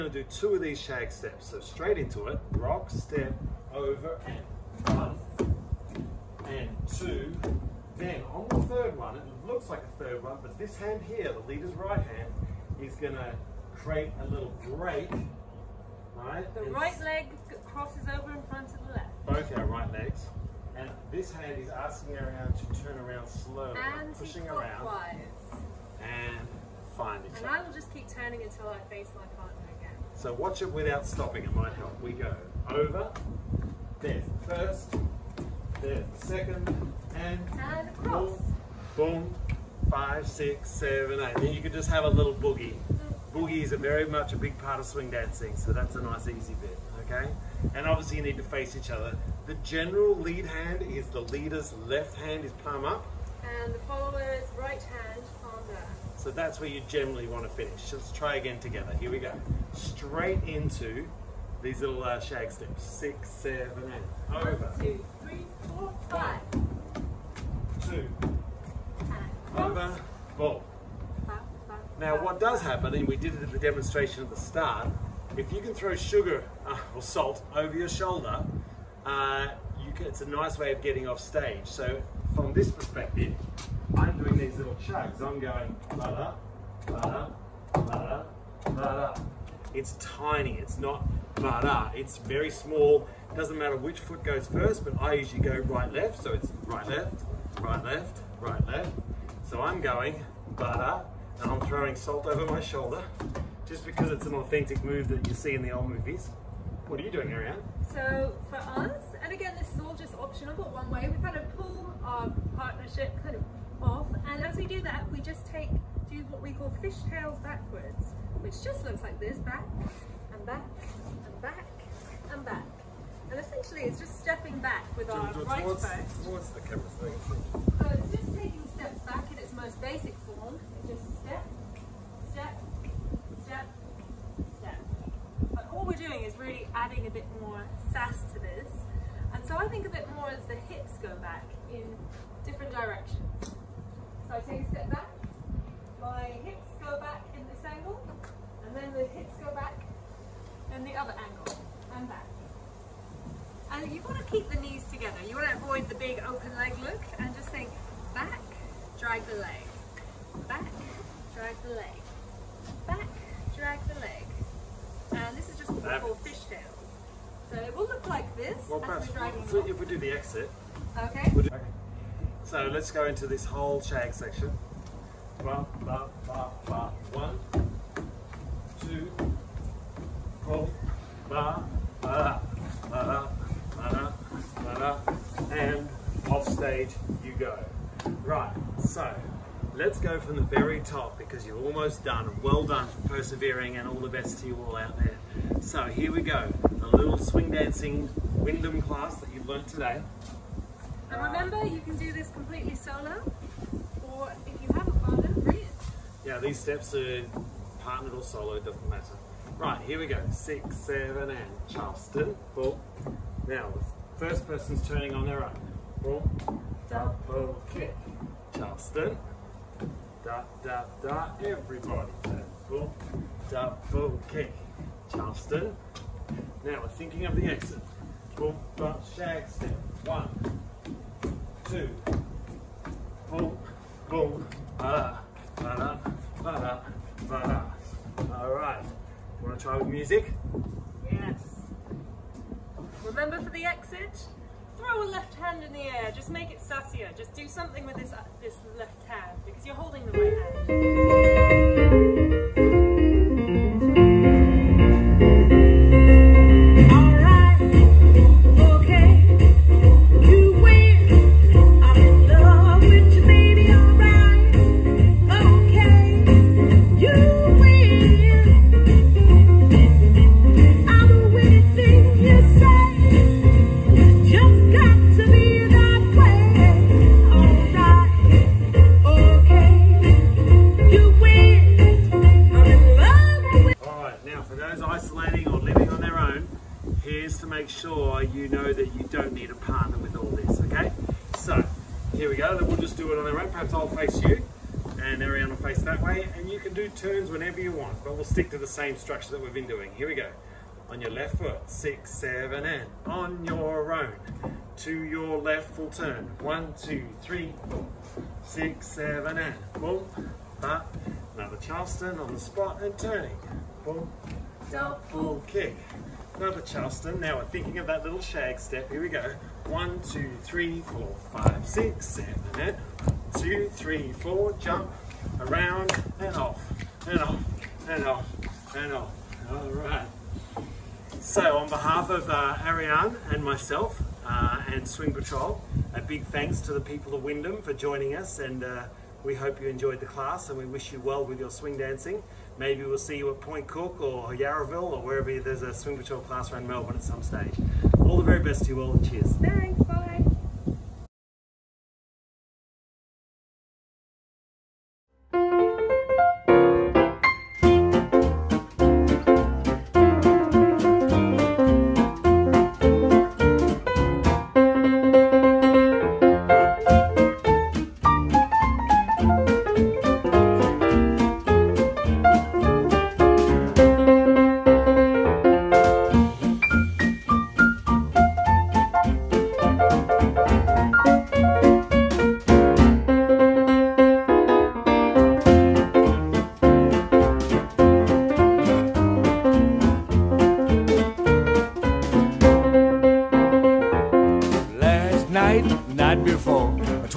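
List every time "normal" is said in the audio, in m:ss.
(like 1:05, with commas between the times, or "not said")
not said.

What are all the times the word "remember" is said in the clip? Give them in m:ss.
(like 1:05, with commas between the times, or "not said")
3:21, 4:03.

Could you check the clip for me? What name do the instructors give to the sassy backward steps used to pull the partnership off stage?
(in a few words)
fishtails.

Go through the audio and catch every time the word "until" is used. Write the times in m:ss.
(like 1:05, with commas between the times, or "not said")
0:28.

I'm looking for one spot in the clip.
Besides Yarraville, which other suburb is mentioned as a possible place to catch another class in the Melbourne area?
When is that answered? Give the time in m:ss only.
5:43.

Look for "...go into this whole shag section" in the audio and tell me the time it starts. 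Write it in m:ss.
2:52.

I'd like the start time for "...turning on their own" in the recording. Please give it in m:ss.
3:34.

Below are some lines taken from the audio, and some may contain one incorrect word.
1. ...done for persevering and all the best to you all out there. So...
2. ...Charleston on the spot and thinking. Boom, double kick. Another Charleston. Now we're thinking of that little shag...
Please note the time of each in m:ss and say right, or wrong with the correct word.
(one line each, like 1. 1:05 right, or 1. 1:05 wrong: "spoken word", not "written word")
1. 3:12 right
2. 5:11 wrong: "turning", not "thinking".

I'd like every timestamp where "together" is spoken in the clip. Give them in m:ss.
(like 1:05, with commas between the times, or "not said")
0:58, 2:34.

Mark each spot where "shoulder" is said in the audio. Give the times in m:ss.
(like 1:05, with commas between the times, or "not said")
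1:17, 1:42.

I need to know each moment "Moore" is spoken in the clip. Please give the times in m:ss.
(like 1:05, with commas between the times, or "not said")
not said.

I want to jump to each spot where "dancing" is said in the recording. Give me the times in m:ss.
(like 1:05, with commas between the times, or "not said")
0:45, 3:17, 5:41.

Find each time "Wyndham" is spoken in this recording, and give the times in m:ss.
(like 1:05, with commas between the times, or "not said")
3:18, 5:37.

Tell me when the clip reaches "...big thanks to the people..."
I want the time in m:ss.
5:36.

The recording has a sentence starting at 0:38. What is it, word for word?
Boom, boom, five, six, seven, eight.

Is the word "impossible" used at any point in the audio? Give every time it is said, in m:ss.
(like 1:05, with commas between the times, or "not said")
not said.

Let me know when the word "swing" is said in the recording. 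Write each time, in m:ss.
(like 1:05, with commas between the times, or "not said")
0:44, 3:17, 5:34, 5:41, 5:45.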